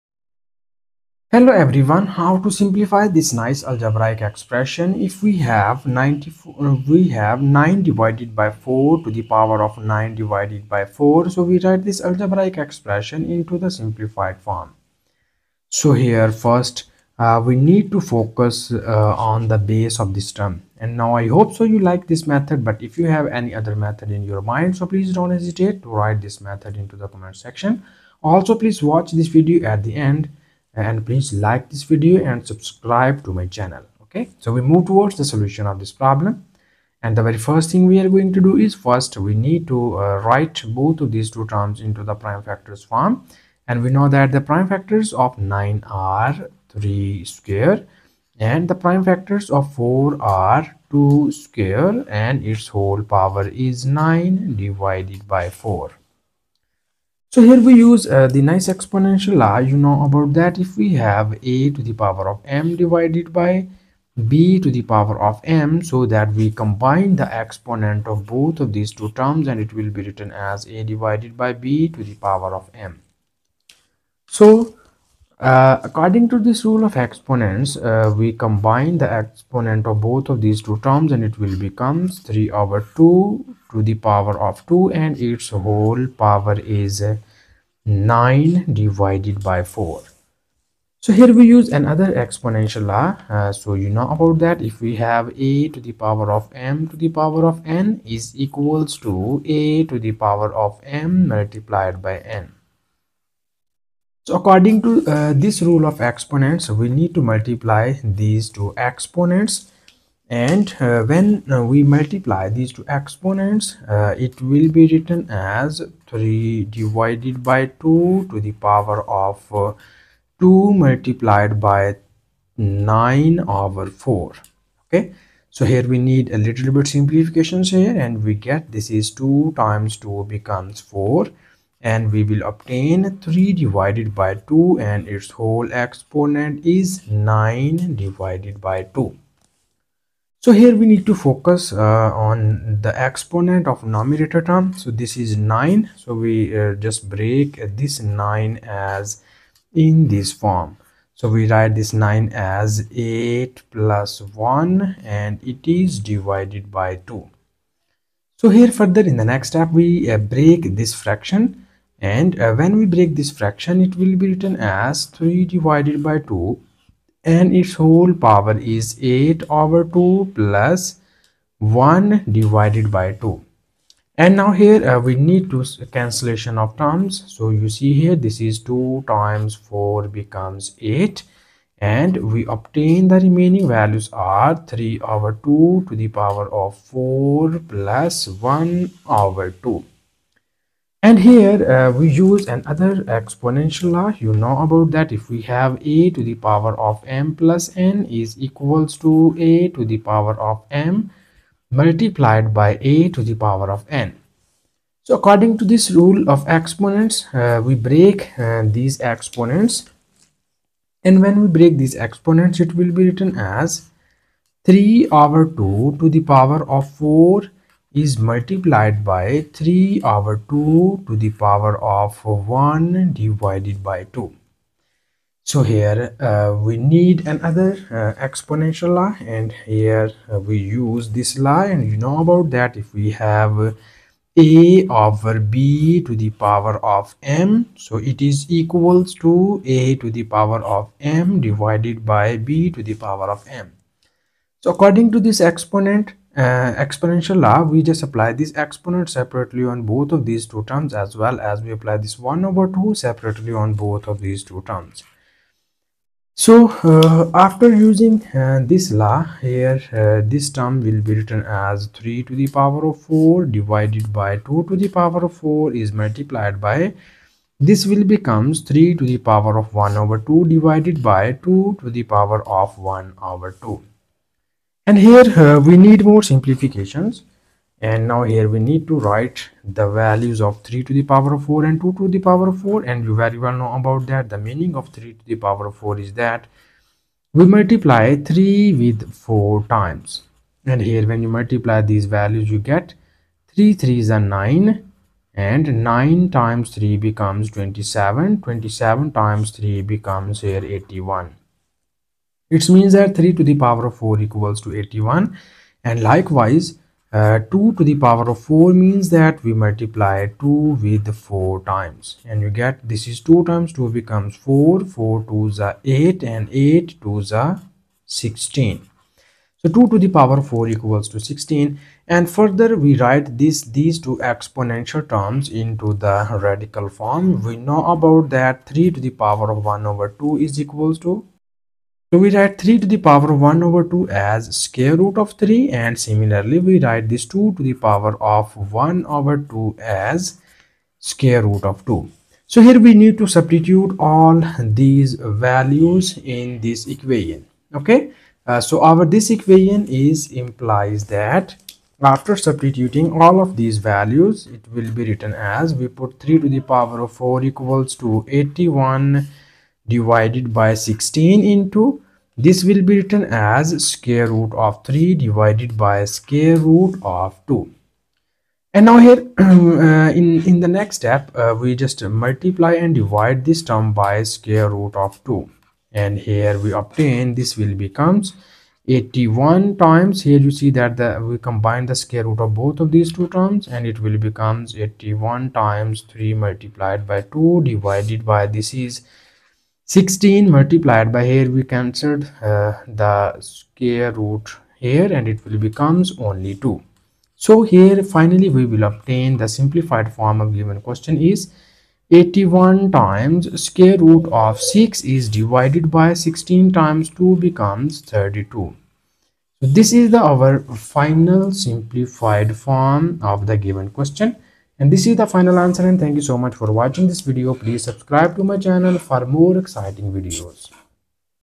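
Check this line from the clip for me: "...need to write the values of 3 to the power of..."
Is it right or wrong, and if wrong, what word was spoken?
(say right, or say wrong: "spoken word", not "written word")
right.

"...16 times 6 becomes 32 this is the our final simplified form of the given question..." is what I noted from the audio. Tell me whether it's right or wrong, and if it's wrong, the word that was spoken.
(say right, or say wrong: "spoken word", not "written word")
wrong: "2", not "6".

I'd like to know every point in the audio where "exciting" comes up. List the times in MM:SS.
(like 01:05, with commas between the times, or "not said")
06:59.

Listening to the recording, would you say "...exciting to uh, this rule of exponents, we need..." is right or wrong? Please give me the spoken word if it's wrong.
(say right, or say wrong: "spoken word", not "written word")
wrong: "according", not "exciting".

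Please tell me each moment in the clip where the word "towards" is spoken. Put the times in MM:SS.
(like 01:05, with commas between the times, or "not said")
00:34.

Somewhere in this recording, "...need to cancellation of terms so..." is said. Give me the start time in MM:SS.
02:55.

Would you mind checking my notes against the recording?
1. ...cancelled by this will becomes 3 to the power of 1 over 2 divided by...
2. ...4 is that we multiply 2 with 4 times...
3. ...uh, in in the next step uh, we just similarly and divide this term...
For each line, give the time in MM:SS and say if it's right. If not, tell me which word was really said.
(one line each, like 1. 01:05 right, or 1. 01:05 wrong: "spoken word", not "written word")
1. 04:25 wrong: "multiplied", not "cancelled"
2. 04:45 wrong: "3", not "2"
3. 06:09 wrong: "multiply", not "similarly".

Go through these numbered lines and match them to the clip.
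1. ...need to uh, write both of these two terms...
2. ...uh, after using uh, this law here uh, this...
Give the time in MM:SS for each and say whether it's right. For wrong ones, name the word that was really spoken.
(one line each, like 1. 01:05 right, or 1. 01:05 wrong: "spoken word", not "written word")
1. 00:39 right
2. 04:16 right.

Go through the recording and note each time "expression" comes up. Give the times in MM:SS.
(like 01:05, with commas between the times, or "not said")
00:04, 00:12.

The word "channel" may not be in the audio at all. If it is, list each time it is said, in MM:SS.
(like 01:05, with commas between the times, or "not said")
00:33, 06:58.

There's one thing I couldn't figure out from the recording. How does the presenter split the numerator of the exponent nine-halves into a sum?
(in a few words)
8 plus 1.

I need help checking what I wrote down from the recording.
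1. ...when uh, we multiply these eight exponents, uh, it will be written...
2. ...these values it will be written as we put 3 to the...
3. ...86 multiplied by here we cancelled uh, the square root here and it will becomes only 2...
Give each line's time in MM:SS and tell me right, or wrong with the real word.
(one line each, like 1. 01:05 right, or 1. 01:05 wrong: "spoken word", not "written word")
1. 01:51 wrong: "two", not "eight"
2. 05:53 right
3. 06:29 wrong: "16", not "86".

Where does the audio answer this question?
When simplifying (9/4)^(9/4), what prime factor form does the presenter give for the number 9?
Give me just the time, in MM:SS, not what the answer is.
00:46.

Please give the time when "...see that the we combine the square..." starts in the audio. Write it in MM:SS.
06:20.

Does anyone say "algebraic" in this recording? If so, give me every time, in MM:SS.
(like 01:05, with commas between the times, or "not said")
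00:03, 00:12.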